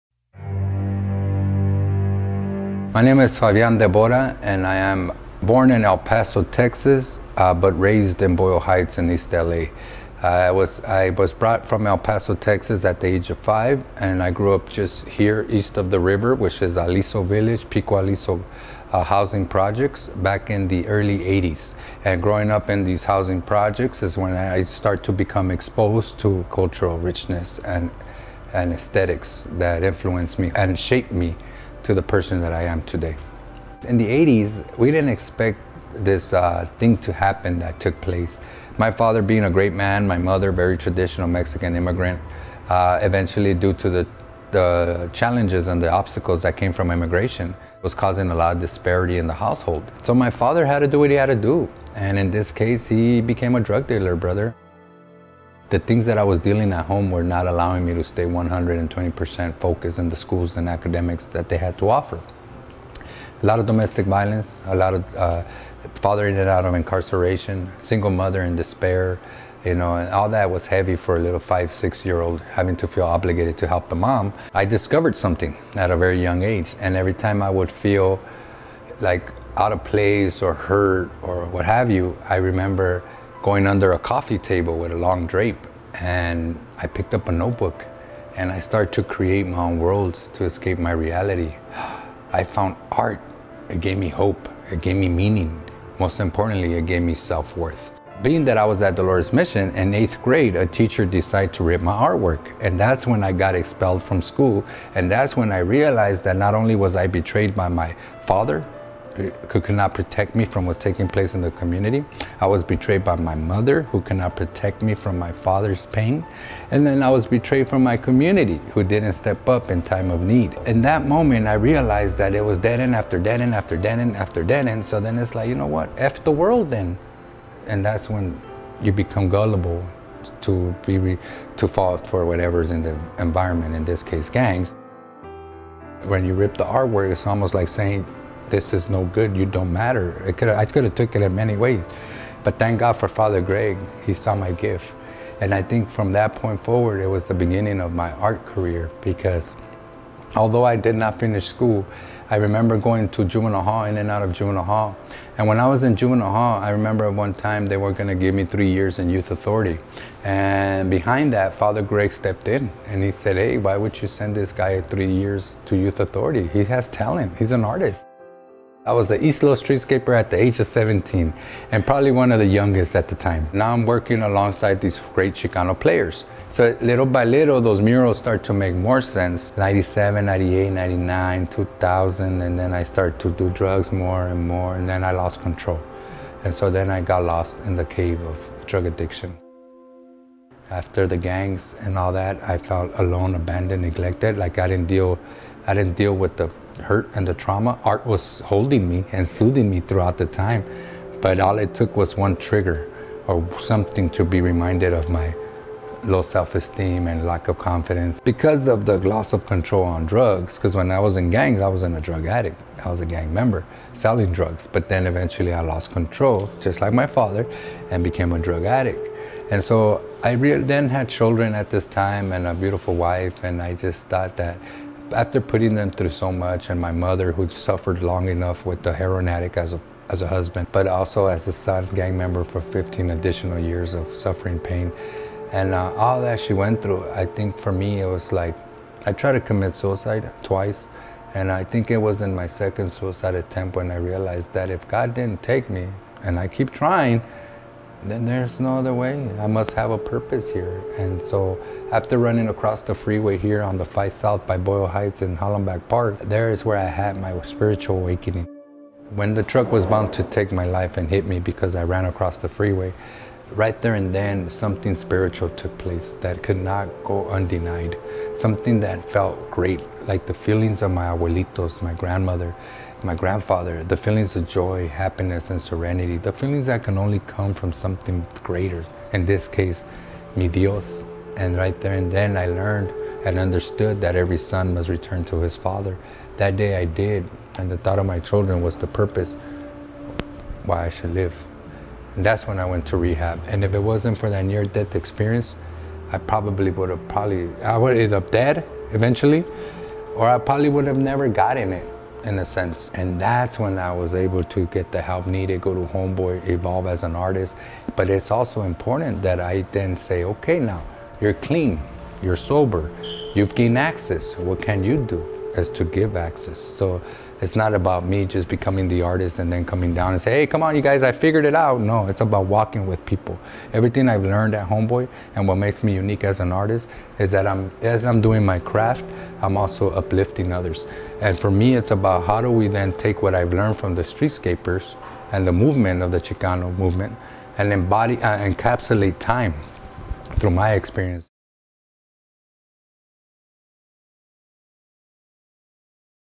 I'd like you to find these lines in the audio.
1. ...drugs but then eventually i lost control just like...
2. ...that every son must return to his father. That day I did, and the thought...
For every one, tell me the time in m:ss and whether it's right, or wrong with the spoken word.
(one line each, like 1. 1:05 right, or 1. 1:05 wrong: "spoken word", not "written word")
1. 3:34 right
2. 4:44 right.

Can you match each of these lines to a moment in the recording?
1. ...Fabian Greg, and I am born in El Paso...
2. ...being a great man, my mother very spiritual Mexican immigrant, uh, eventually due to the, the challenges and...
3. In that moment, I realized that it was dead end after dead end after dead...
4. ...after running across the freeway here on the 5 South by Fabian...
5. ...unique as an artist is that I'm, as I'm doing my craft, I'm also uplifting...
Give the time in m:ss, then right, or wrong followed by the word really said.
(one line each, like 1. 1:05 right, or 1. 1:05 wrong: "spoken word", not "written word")
1. 0:03 wrong: "Debora", not "Greg"
2. 0:39 wrong: "traditional", not "spiritual"
3. 2:00 right
4. 4:11 wrong: "Boyle", not "Fabian"
5. 5:25 right.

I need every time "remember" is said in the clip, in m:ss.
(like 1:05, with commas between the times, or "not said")
1:22, 2:32, 2:36.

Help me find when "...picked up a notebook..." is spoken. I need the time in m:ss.
1:26.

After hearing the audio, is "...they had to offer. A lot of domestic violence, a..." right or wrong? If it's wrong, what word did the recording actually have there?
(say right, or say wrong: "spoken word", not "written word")
right.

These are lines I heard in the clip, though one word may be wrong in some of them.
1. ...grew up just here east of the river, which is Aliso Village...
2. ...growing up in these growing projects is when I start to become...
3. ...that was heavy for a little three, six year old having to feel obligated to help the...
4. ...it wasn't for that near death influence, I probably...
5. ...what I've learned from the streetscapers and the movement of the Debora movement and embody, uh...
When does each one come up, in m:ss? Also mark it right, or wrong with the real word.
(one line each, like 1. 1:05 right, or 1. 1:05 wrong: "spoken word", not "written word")
1. 0:14 right
2. 0:22 wrong: "housing", not "growing"
3. 1:10 wrong: "five", not "three"
4. 4:53 wrong: "experience", not "influence"
5. 5:33 wrong: "Chicano", not "Debora".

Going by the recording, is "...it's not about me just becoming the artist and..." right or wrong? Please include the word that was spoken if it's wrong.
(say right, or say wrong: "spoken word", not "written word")
right.